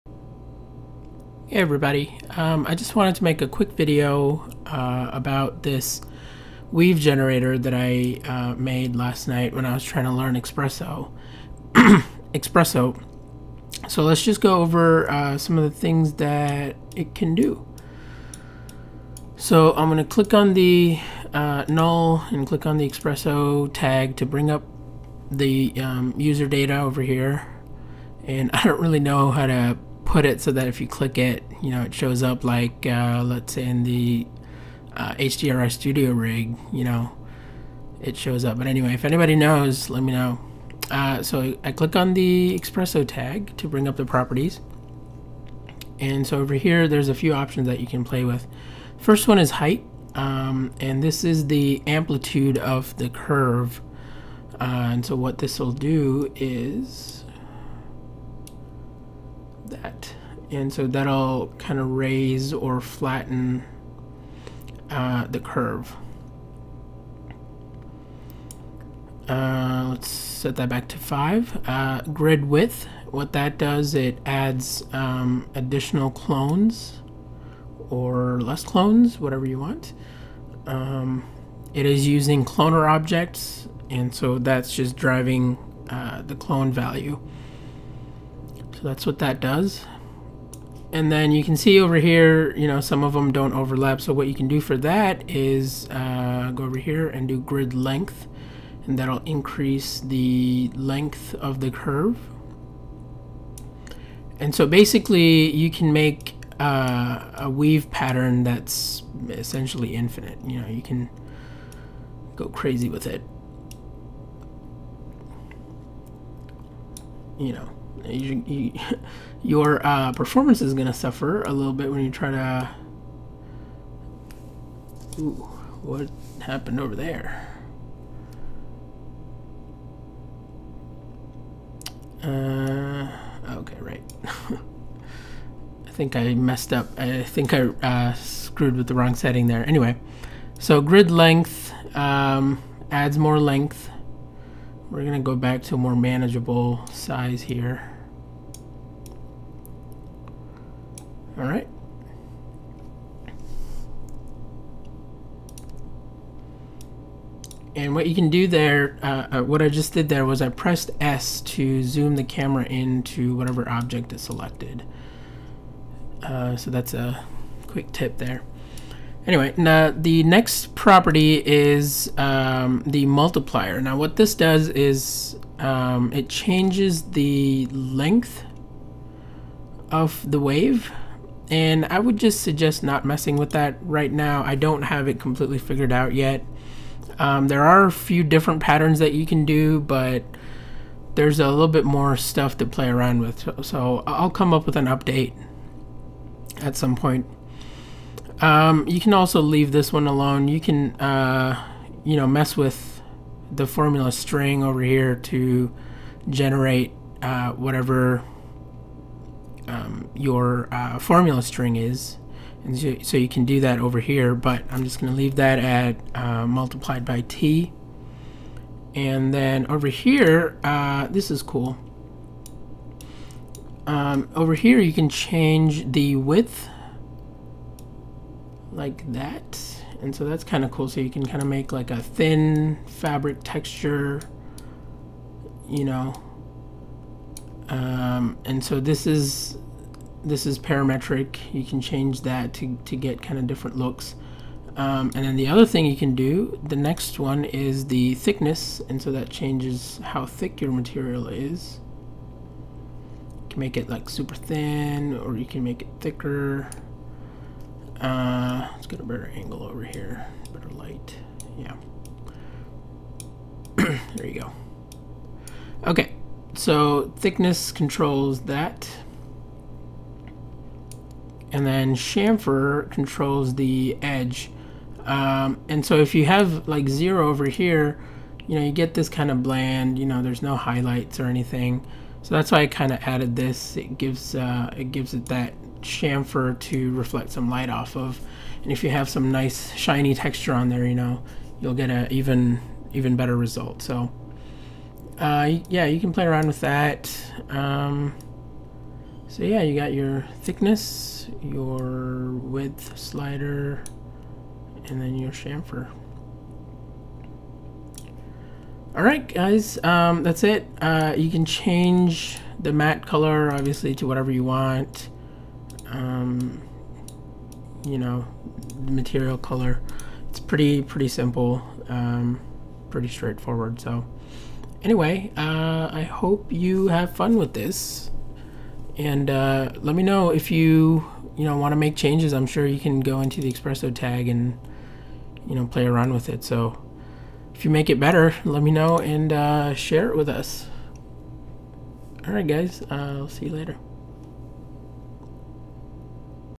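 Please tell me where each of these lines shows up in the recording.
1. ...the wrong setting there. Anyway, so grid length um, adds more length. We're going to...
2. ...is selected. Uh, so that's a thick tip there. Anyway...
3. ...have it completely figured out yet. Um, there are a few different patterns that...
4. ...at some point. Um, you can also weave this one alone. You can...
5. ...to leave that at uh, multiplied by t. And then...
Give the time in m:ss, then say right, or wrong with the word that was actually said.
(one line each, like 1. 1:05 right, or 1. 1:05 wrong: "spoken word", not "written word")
1. 2:18 right
2. 2:44 wrong: "quick", not "thick"
3. 3:04 right
4. 3:16 wrong: "leave", not "weave"
5. 3:35 right.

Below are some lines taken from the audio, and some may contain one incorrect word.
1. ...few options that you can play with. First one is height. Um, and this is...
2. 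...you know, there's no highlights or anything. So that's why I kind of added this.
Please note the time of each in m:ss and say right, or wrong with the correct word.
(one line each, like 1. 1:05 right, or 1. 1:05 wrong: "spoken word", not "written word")
1. 0:47 right
2. 4:39 right.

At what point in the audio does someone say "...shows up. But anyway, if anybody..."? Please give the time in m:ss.
0:38.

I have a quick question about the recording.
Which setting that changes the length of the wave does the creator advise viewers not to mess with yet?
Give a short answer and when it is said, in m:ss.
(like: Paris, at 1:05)
The multiplier, at 2:52.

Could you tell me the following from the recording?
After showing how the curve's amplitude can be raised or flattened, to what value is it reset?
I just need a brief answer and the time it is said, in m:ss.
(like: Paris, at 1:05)
5, at 1:10.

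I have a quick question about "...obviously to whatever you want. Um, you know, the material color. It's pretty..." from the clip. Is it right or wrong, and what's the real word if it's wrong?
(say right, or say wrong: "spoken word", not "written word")
right.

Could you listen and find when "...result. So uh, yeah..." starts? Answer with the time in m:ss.
4:53.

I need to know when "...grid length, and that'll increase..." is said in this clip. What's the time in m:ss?
1:37.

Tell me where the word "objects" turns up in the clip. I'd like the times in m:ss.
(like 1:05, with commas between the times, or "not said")
1:22, 2:43.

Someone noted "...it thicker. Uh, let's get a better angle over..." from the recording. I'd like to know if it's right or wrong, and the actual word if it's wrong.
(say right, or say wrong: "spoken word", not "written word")
right.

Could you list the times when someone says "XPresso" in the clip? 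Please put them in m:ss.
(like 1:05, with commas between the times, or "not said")
0:42, 5:33.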